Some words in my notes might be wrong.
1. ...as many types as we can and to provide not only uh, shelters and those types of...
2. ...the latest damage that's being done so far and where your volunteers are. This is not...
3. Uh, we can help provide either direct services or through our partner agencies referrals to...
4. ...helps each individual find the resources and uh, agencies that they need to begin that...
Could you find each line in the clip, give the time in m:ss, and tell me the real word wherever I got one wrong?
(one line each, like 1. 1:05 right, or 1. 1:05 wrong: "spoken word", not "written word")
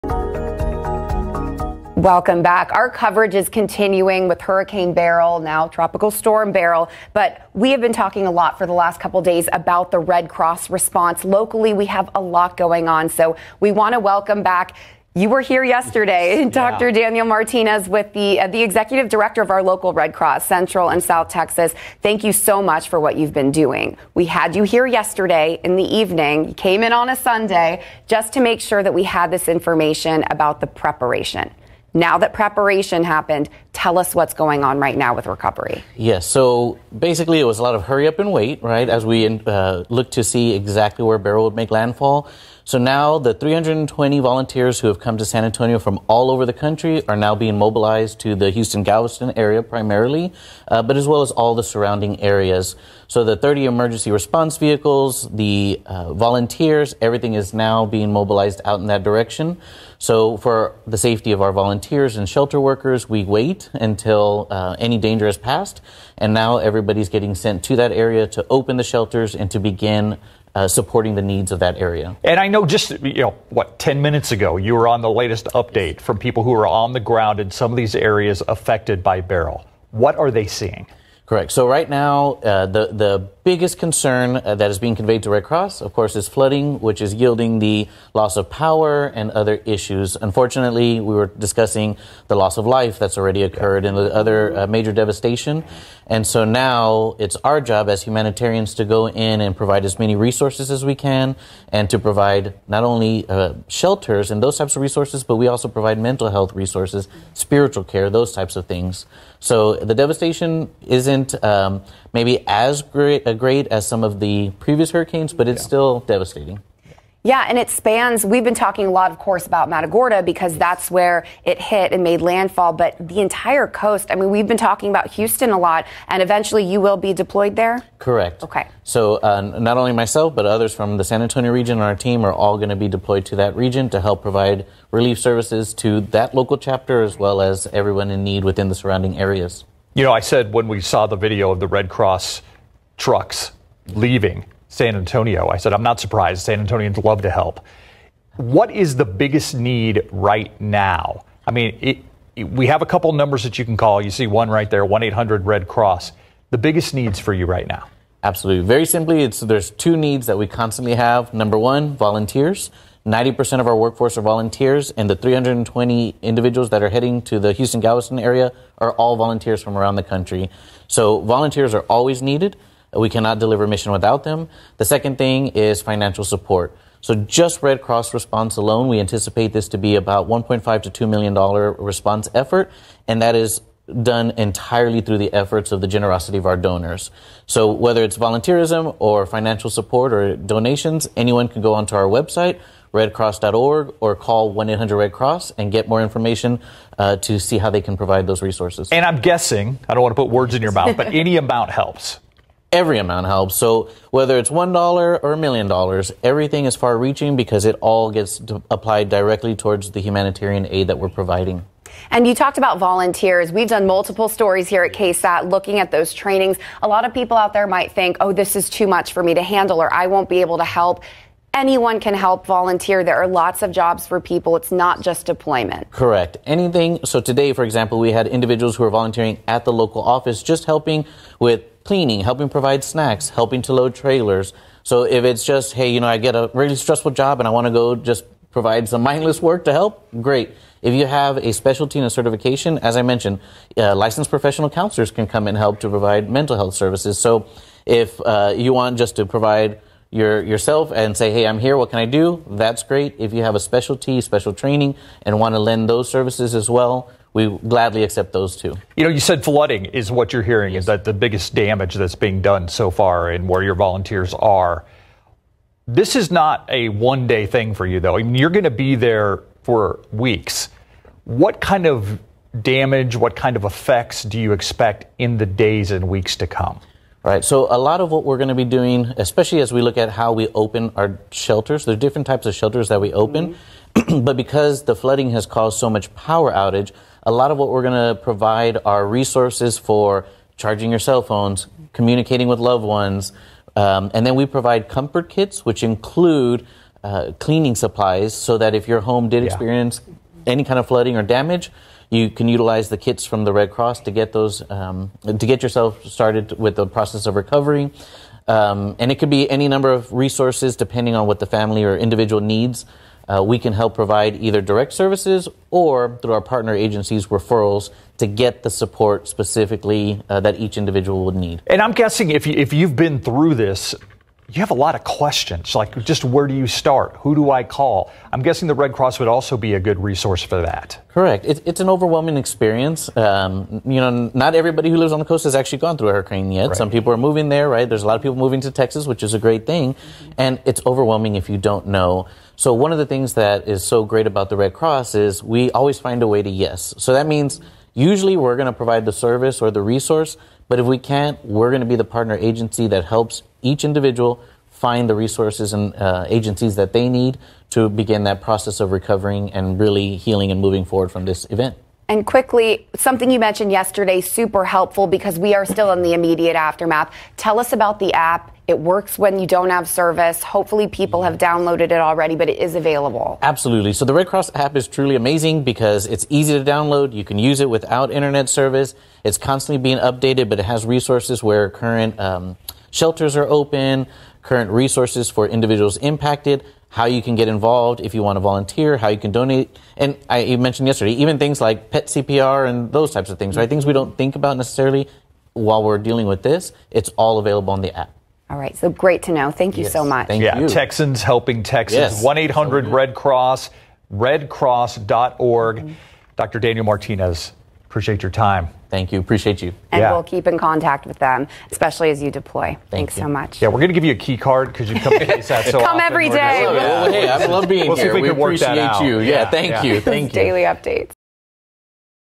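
1. 1:39 wrong: "resources", not "types"
2. 4:21 wrong: "biggest", not "latest"
3. 5:13 right
4. 5:53 right.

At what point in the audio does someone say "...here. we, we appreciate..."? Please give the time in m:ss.
6:57.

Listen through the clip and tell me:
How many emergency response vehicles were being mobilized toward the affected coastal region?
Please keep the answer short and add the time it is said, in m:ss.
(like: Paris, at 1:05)
30, at 0:53.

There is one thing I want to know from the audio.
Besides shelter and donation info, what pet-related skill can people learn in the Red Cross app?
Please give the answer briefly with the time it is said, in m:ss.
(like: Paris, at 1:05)
Pet CPR, at 6:31.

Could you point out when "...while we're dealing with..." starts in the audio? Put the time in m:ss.
6:35.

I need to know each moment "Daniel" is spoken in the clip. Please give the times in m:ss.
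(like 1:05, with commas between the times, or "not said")
0:16, 6:46.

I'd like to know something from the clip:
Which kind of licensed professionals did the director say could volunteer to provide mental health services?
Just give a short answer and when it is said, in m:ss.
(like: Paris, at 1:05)
Licensed professional counselors, at 4:03.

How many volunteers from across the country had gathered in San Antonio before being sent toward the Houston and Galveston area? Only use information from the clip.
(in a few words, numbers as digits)
320.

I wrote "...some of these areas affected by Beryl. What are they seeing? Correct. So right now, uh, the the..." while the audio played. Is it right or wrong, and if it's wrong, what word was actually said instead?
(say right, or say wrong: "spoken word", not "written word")
right.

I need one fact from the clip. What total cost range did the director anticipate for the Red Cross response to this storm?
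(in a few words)
1.5 to 2 million dollars.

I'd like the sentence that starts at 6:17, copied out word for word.
You can use it without internet service.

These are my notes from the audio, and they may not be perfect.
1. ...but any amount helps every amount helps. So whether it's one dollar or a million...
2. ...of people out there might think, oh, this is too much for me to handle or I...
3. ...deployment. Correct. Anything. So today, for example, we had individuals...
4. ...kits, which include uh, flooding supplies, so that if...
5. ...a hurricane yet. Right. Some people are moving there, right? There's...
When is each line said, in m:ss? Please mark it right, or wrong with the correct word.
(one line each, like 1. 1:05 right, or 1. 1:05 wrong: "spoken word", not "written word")
1. 3:20 right
2. 3:37 right
3. 3:45 right
4. 4:55 wrong: "cleaning", not "flooding"
5. 5:36 right.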